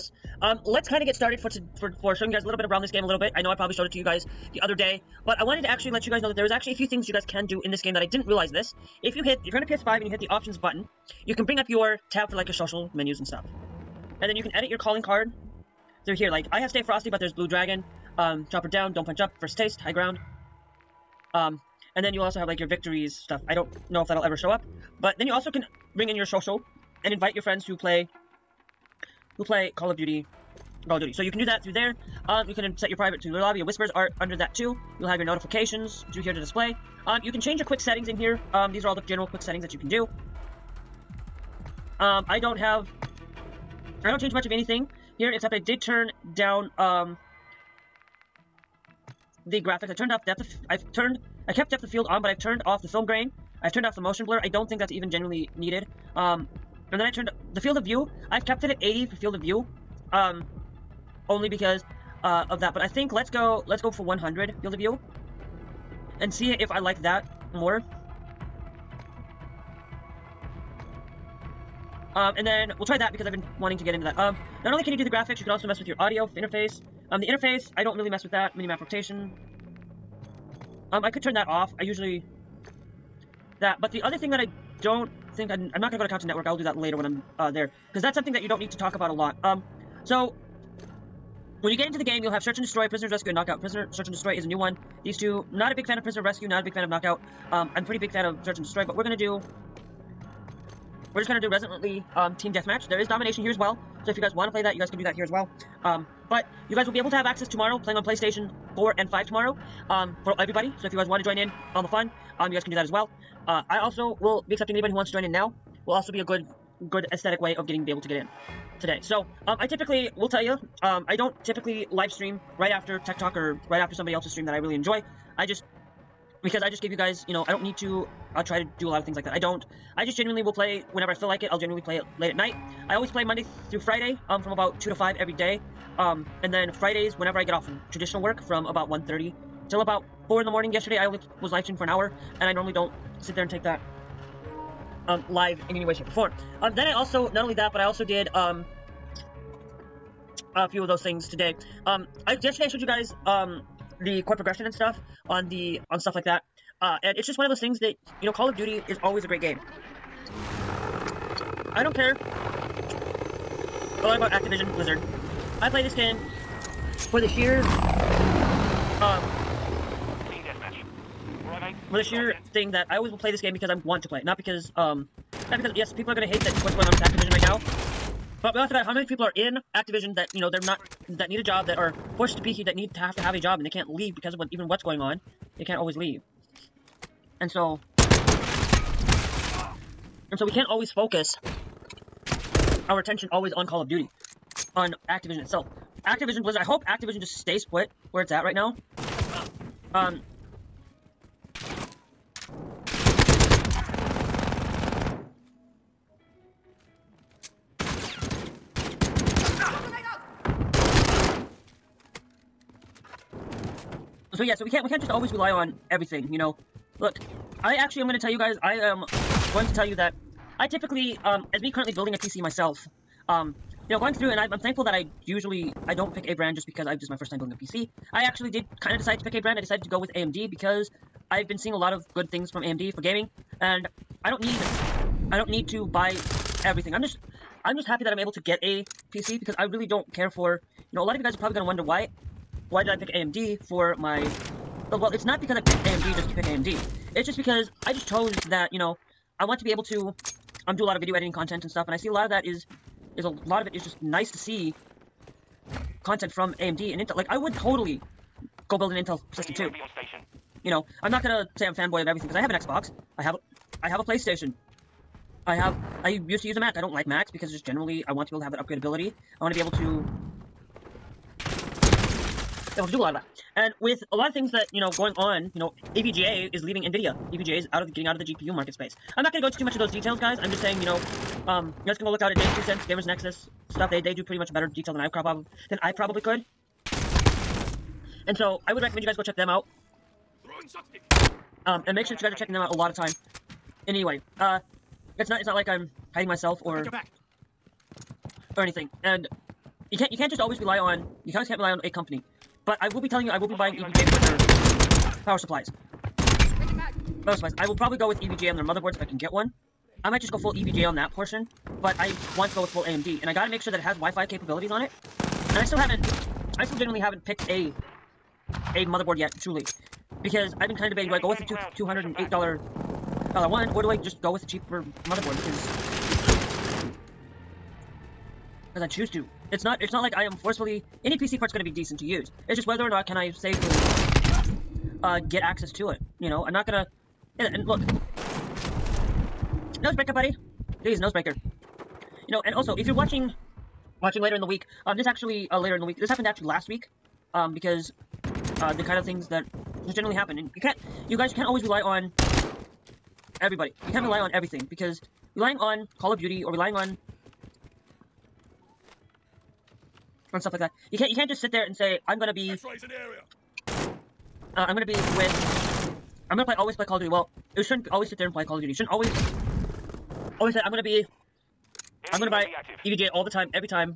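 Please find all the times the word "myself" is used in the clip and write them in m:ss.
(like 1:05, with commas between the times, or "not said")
3:42, 4:56.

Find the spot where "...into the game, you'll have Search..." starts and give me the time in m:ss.
1:31.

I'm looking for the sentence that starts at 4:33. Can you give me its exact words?
And with a lot of things that, you know, going on, you know, EVGA is leaving NVIDIA.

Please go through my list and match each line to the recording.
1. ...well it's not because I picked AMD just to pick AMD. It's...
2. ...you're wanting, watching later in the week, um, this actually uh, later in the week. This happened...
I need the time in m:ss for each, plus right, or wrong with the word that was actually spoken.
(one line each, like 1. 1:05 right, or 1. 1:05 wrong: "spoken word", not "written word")
1. 4:04 right
2. 5:42 wrong: "watching", not "wanting".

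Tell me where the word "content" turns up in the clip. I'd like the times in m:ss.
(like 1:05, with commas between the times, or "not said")
1:26, 4:11, 4:16.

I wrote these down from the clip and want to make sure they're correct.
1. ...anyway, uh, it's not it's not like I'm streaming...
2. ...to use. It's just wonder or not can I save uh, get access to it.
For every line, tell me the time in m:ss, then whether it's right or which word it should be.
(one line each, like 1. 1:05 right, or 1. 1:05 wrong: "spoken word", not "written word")
1. 4:53 wrong: "hiding", not "streaming"
2. 5:31 wrong: "whether", not "wonder".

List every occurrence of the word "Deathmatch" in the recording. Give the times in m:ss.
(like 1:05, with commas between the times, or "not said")
1:42.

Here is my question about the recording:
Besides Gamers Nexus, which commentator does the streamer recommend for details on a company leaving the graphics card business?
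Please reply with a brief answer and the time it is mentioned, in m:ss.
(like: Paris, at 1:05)
James Two Cents, at 4:42.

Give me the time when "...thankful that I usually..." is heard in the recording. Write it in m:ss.
3:44.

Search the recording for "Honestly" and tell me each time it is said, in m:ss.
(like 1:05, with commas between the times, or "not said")
6:10.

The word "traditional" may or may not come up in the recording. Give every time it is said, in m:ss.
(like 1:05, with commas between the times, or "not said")
2:17.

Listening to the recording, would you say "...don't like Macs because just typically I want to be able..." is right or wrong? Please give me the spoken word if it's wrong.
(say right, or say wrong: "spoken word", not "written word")
wrong: "generally", not "typically".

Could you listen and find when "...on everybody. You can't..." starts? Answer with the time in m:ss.
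5:51.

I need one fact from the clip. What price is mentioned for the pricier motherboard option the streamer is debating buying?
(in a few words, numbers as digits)
$208.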